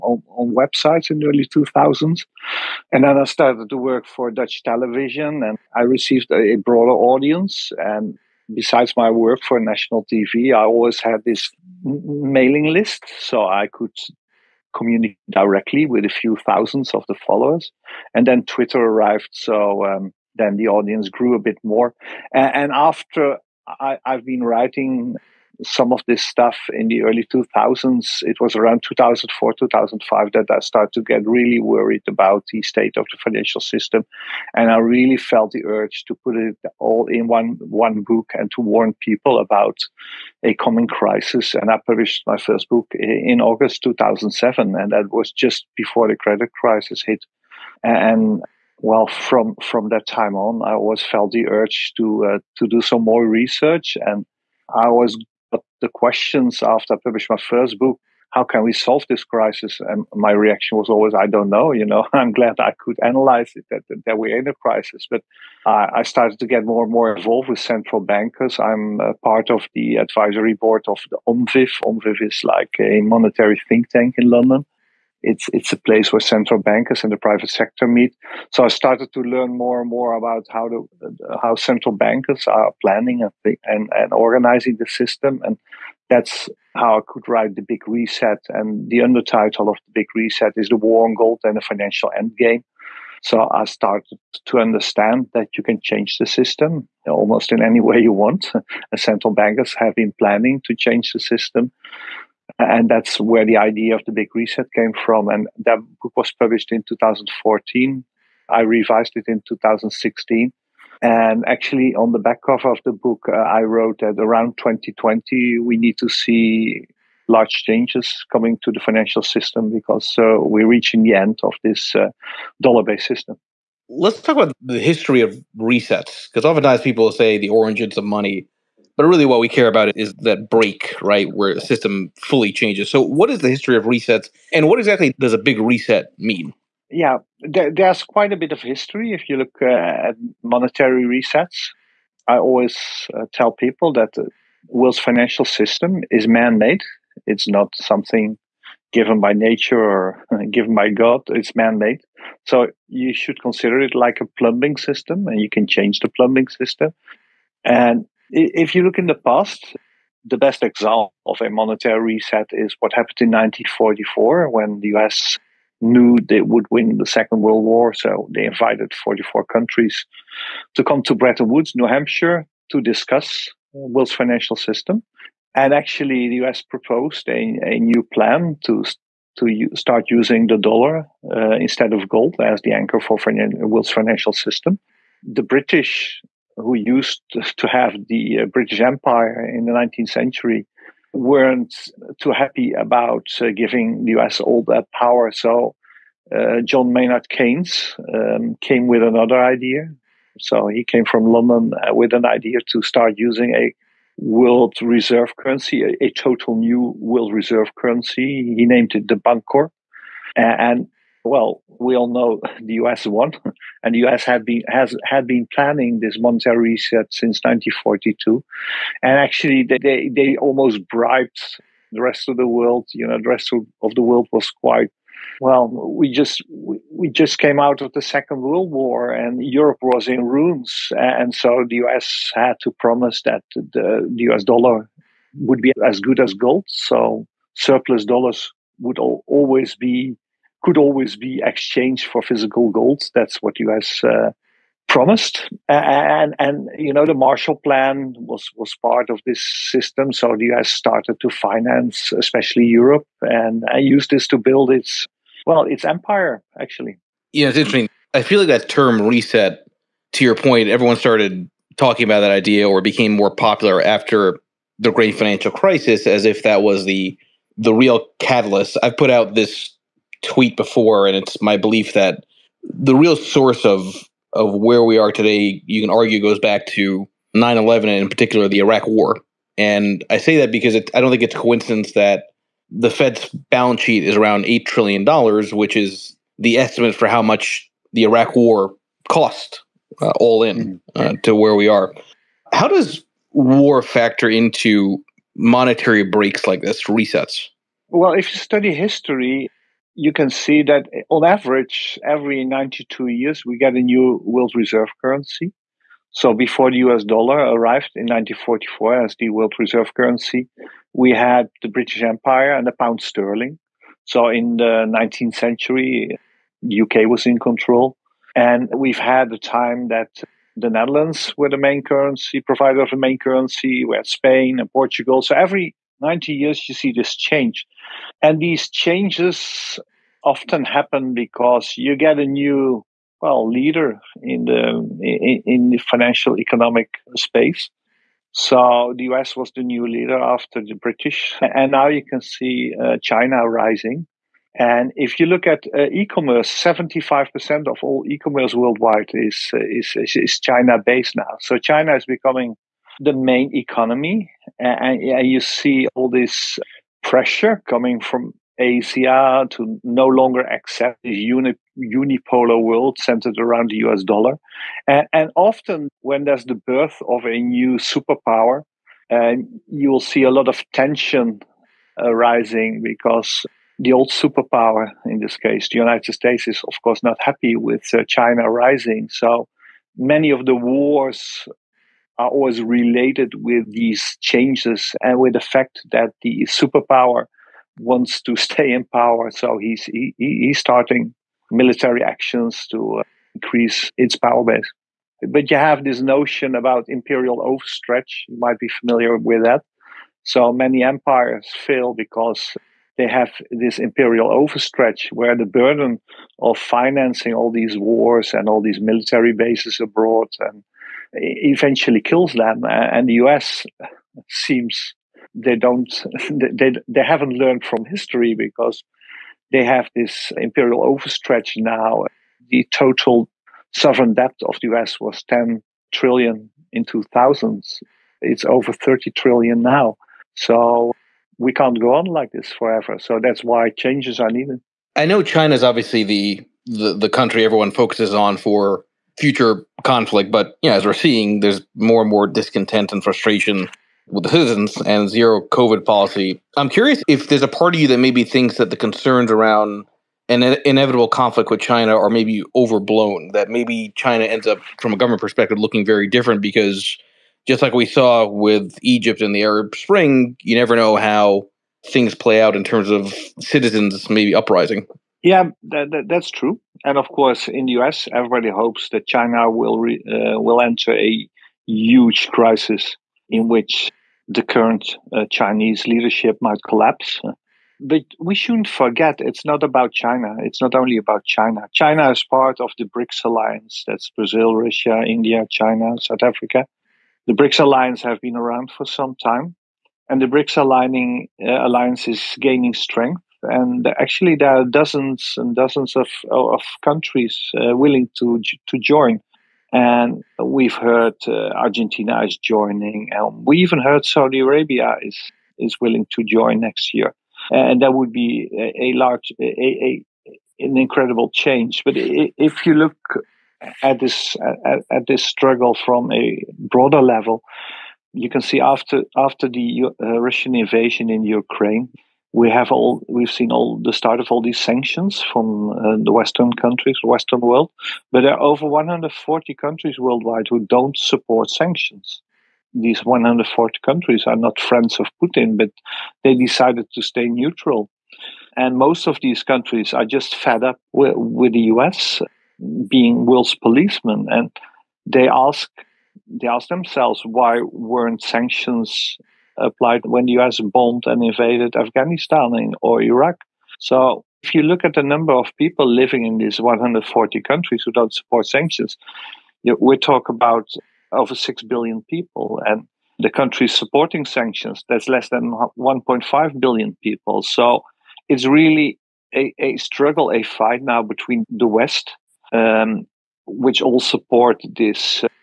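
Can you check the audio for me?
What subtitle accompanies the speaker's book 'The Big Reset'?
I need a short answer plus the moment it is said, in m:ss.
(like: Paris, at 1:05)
The war on gold and the financial endgame, at 1:30.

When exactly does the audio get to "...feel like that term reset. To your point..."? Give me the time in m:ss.
4:18.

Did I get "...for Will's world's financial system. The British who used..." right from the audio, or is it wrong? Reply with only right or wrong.
right.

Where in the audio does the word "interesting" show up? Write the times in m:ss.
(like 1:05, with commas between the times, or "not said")
4:17.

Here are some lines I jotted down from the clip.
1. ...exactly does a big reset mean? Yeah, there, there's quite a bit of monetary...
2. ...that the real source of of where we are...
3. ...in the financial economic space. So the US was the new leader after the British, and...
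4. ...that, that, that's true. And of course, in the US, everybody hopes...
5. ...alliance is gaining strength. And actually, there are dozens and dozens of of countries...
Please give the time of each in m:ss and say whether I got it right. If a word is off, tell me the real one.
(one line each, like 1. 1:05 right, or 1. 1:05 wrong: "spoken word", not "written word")
1. 2:14 wrong: "history", not "monetary"
2. 4:31 right
3. 5:35 right
4. 7:45 right
5. 8:11 right.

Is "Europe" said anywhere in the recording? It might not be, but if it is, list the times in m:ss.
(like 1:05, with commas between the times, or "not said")
3:49, 4:12.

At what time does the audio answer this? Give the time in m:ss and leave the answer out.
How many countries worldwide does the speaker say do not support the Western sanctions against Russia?
8:48.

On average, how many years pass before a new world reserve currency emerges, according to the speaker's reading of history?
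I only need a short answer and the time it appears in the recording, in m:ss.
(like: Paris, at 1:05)
92, at 5:02.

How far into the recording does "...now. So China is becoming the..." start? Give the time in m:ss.
5:51.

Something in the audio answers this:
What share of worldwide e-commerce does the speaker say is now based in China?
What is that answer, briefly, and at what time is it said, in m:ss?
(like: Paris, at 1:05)
75%, at 5:46.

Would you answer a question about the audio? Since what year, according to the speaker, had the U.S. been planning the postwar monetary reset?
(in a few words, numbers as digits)
1942.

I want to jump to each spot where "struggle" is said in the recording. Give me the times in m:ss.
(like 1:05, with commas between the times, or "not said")
8:35, 9:29.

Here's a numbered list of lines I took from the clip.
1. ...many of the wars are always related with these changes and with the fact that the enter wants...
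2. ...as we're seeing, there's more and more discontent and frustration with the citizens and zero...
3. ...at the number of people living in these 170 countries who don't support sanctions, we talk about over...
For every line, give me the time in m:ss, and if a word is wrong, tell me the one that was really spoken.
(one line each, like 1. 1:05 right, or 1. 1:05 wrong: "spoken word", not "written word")
1. 6:19 wrong: "superpower", not "enter"
2. 7:20 right
3. 9:14 wrong: "140", not "170".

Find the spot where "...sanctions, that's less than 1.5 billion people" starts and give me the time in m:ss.
9:24.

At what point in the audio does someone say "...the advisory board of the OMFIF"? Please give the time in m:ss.
1:09.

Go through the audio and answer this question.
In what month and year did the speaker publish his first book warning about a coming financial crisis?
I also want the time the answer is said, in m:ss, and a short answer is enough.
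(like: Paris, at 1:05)
August 2007, at 0:43.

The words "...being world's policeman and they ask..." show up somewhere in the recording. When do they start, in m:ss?
9:02.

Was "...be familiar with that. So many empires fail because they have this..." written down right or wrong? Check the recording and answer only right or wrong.
right.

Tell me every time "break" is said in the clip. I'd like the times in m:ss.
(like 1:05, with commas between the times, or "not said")
2:10, 4:56.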